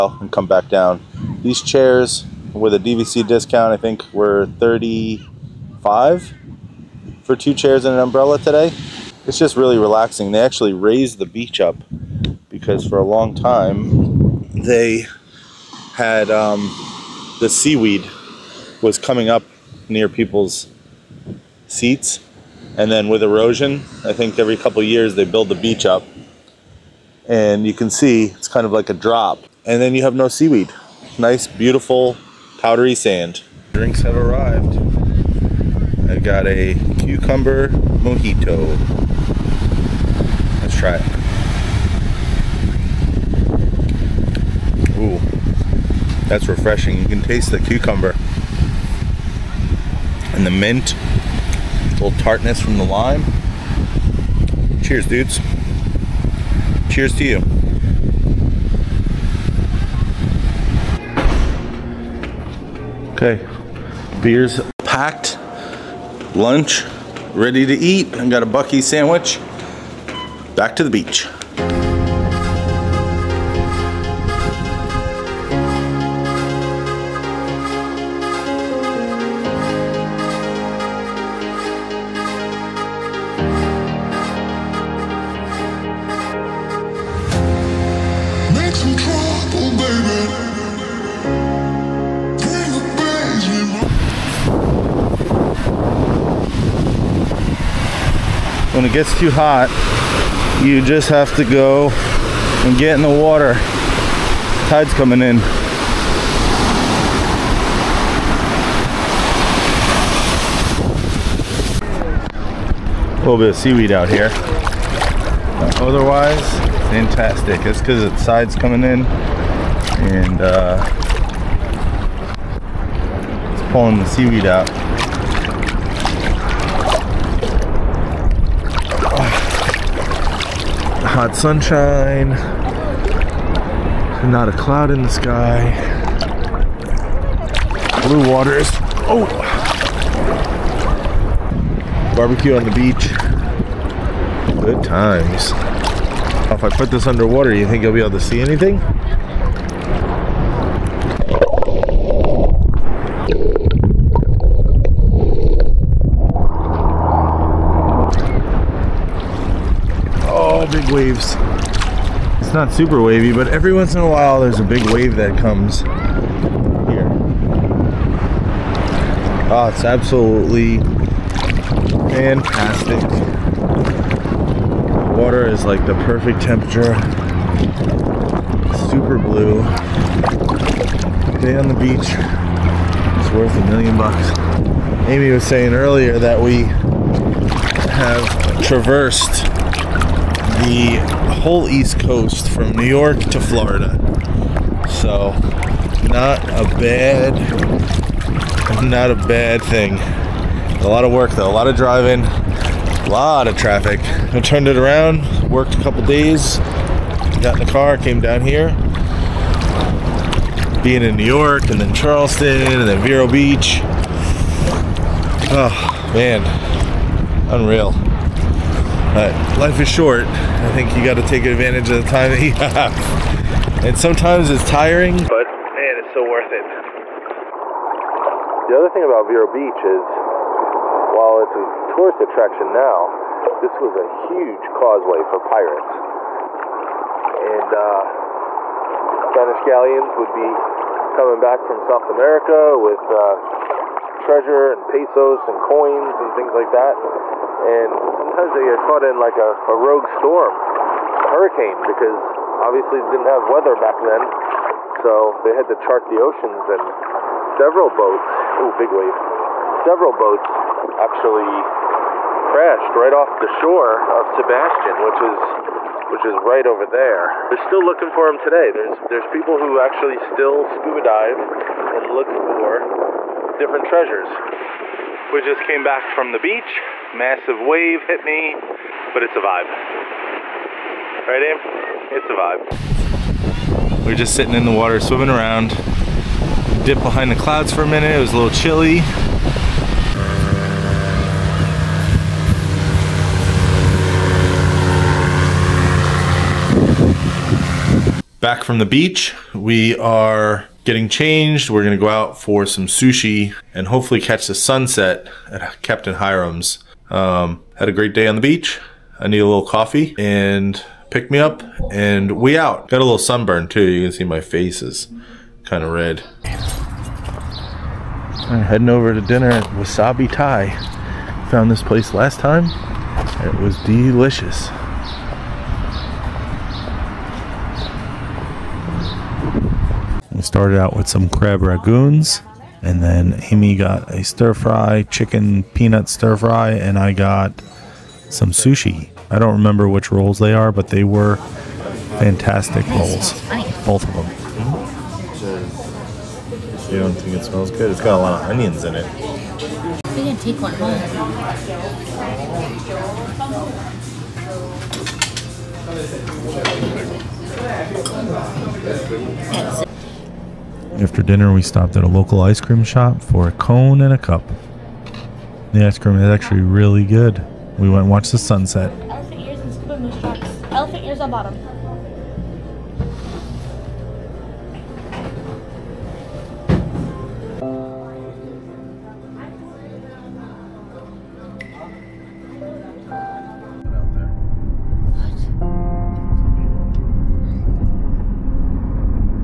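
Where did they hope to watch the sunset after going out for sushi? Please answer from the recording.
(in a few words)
Captain Hiram's.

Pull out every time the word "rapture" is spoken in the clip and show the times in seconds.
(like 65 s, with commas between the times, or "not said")
not said.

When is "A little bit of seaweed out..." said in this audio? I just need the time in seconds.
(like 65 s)
113 s.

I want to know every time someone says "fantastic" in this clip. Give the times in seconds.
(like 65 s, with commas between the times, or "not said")
116 s, 172 s, 342 s.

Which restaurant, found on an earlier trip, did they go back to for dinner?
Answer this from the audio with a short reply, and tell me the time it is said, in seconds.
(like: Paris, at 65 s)
Wasabi Thai, at 319 s.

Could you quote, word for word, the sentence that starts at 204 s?
I turned it around, worked a couple days, got in the car, came down here.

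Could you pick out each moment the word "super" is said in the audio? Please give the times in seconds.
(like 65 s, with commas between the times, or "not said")
162 s, 178 s.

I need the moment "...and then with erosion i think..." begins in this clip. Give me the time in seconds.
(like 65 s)
22 s.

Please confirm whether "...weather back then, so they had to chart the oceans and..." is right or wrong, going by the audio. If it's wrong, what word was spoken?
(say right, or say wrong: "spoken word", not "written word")
right.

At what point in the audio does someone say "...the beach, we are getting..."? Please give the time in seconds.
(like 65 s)
298 s.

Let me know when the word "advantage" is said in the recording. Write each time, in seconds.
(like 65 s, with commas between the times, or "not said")
221 s.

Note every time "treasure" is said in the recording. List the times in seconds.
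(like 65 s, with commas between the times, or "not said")
244 s, 273 s.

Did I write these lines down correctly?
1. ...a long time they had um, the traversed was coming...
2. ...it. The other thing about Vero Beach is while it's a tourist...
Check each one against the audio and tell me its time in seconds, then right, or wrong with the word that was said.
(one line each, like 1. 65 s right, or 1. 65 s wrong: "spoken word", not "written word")
1. 12 s wrong: "seaweed", not "traversed"
2. 226 s right.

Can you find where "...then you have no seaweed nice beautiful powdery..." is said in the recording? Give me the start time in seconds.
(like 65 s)
29 s.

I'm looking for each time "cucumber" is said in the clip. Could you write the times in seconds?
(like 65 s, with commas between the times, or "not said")
36 s, 47 s.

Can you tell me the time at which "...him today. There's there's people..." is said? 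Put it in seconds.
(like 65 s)
268 s.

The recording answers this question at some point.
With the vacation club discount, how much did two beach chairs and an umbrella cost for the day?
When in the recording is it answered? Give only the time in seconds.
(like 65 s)
4 s.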